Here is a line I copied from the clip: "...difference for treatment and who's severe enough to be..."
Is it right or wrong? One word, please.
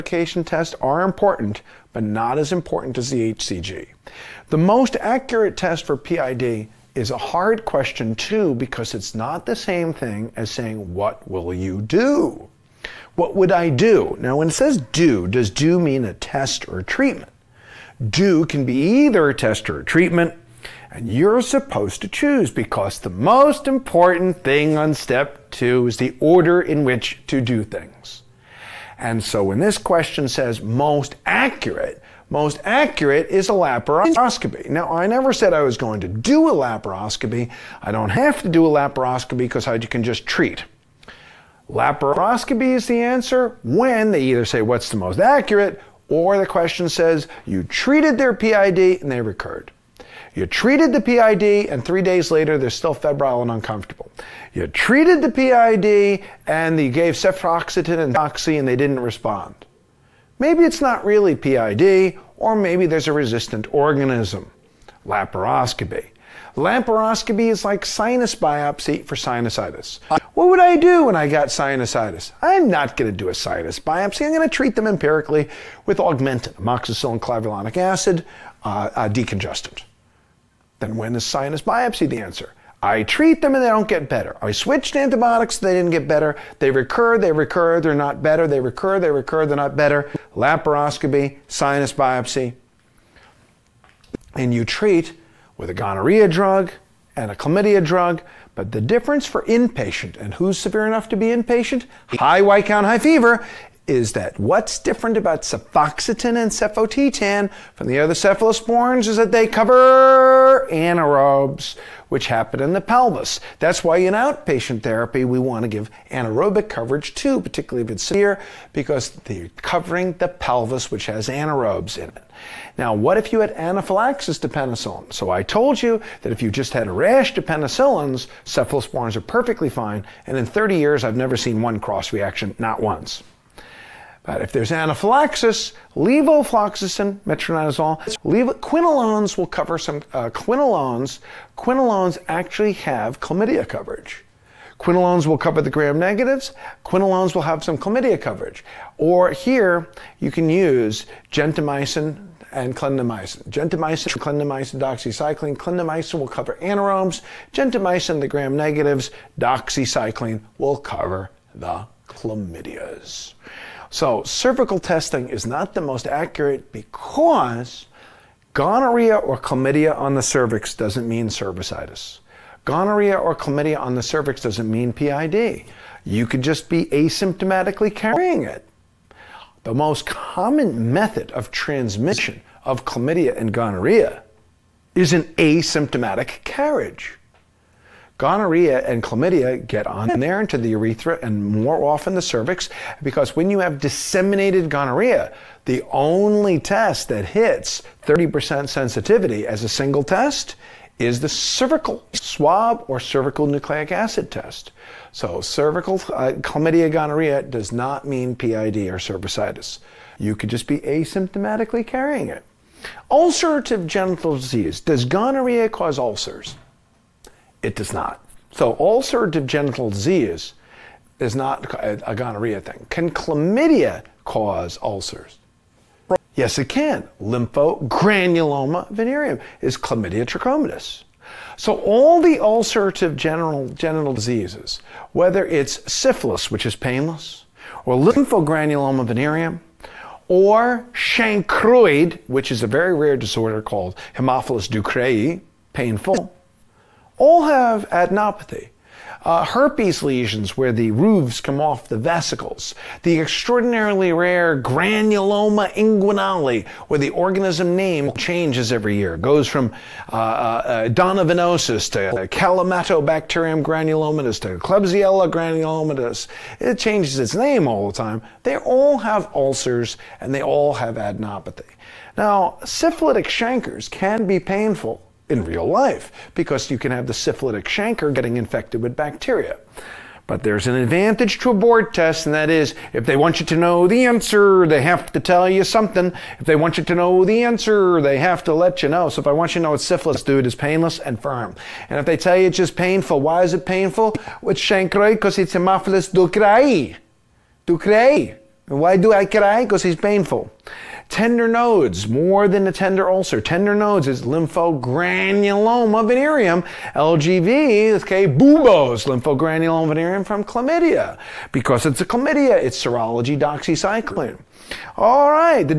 wrong.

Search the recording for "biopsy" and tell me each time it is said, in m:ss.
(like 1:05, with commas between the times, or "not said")
1:08, 1:13, 1:21, 1:31.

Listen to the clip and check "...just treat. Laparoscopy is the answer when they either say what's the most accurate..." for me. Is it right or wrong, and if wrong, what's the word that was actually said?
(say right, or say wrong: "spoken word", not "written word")
right.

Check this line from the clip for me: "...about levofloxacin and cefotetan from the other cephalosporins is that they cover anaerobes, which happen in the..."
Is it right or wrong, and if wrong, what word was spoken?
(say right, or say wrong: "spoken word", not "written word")
wrong: "cefoxitin", not "levofloxacin".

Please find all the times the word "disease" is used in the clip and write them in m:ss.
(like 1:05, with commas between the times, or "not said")
3:34, 3:39, 3:54.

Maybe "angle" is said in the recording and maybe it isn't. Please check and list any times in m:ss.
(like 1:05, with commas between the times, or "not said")
not said.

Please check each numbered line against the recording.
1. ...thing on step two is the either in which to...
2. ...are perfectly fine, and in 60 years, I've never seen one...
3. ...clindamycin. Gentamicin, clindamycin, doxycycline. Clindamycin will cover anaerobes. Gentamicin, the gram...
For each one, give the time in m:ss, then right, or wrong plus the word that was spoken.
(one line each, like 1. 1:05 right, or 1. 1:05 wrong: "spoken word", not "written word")
1. 0:24 wrong: "order", not "either"
2. 2:09 wrong: "30", not "60"
3. 2:32 right.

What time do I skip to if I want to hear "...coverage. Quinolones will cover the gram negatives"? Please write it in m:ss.
2:23.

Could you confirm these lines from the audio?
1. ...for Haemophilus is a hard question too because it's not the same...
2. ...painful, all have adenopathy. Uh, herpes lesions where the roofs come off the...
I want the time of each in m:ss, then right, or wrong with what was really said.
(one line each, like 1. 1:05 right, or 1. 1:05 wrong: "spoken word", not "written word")
1. 0:05 wrong: "PID", not "Haemophilus"
2. 4:05 right.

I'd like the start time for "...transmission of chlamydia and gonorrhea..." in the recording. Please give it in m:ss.
3:01.